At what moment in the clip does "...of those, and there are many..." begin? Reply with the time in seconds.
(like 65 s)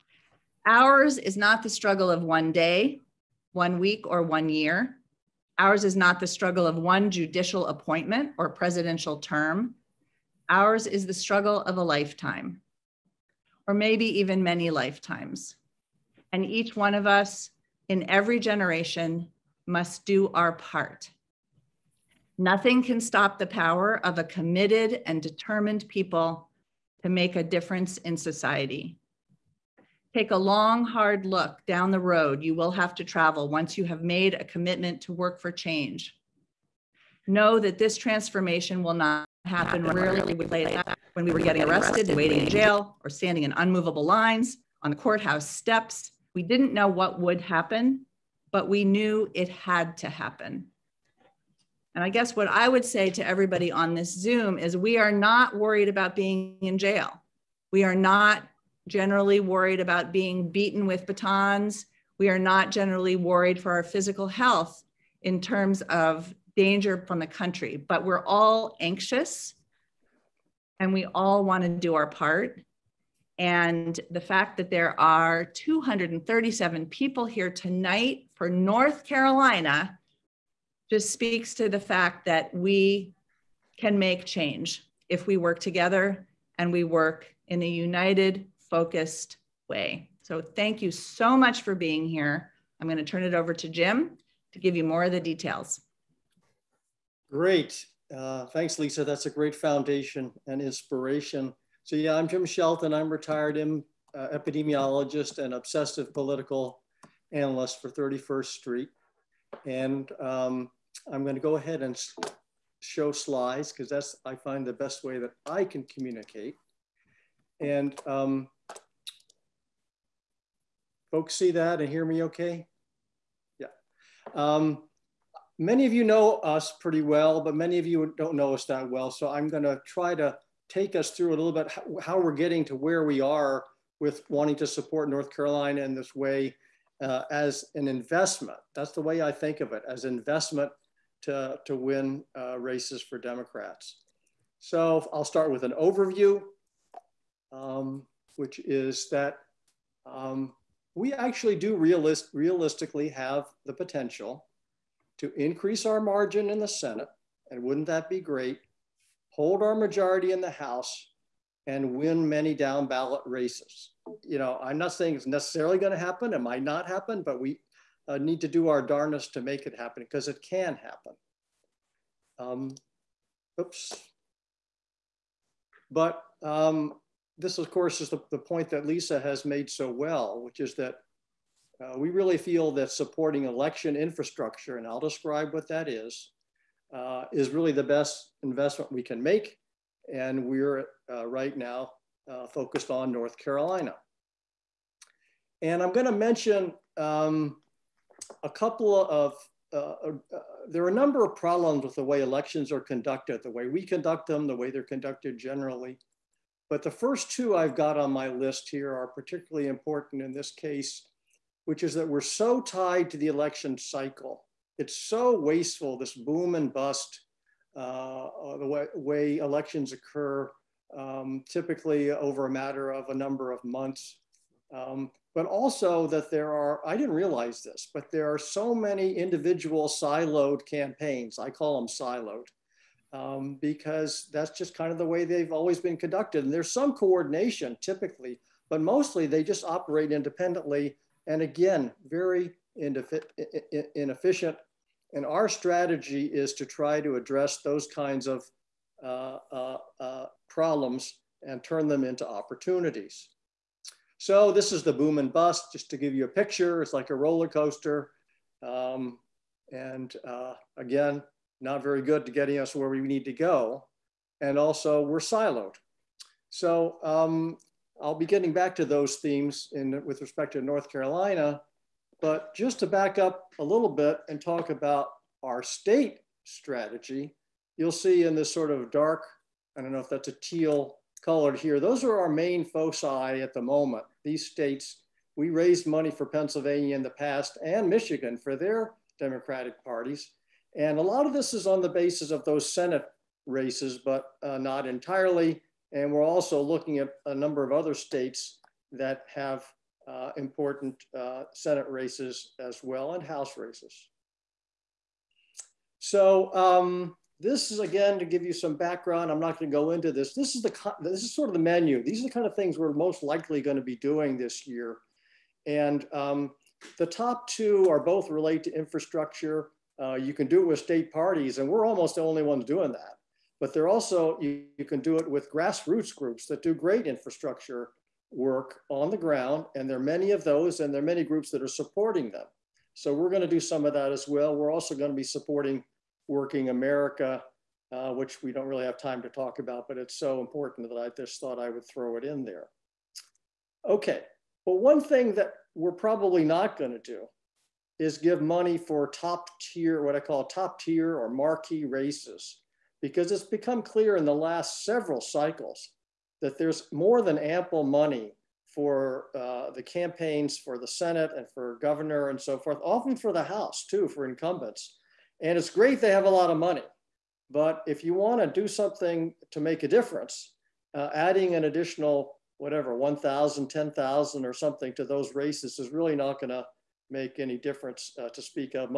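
330 s.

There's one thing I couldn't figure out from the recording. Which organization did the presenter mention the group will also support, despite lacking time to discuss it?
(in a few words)
Working America.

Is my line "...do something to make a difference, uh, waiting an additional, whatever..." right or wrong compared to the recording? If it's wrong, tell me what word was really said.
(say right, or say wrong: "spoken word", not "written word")
wrong: "adding", not "waiting".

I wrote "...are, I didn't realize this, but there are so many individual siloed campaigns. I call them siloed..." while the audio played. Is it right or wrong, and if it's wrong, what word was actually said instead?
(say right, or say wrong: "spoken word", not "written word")
right.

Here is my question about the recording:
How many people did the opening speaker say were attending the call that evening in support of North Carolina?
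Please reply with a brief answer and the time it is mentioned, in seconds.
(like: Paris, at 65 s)
237, at 75 s.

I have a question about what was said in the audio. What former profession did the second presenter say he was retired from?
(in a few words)
epidemiologist.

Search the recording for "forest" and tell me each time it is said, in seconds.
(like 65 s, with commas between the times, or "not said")
not said.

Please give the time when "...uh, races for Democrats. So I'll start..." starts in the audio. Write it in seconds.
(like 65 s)
142 s.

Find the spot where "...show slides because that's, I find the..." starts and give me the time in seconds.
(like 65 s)
112 s.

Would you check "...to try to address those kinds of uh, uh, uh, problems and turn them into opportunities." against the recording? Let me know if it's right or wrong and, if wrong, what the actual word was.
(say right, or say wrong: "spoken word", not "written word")
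right.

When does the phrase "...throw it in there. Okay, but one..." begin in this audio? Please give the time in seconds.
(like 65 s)
341 s.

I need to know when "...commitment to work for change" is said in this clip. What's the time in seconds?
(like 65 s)
34 s.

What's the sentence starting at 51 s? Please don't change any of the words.
And I guess what I would say to everybody on this Zoom is we are not worried about being in jail.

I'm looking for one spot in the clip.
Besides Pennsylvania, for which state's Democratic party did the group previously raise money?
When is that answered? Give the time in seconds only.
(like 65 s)
287 s.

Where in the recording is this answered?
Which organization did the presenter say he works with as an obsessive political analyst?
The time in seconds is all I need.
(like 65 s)
107 s.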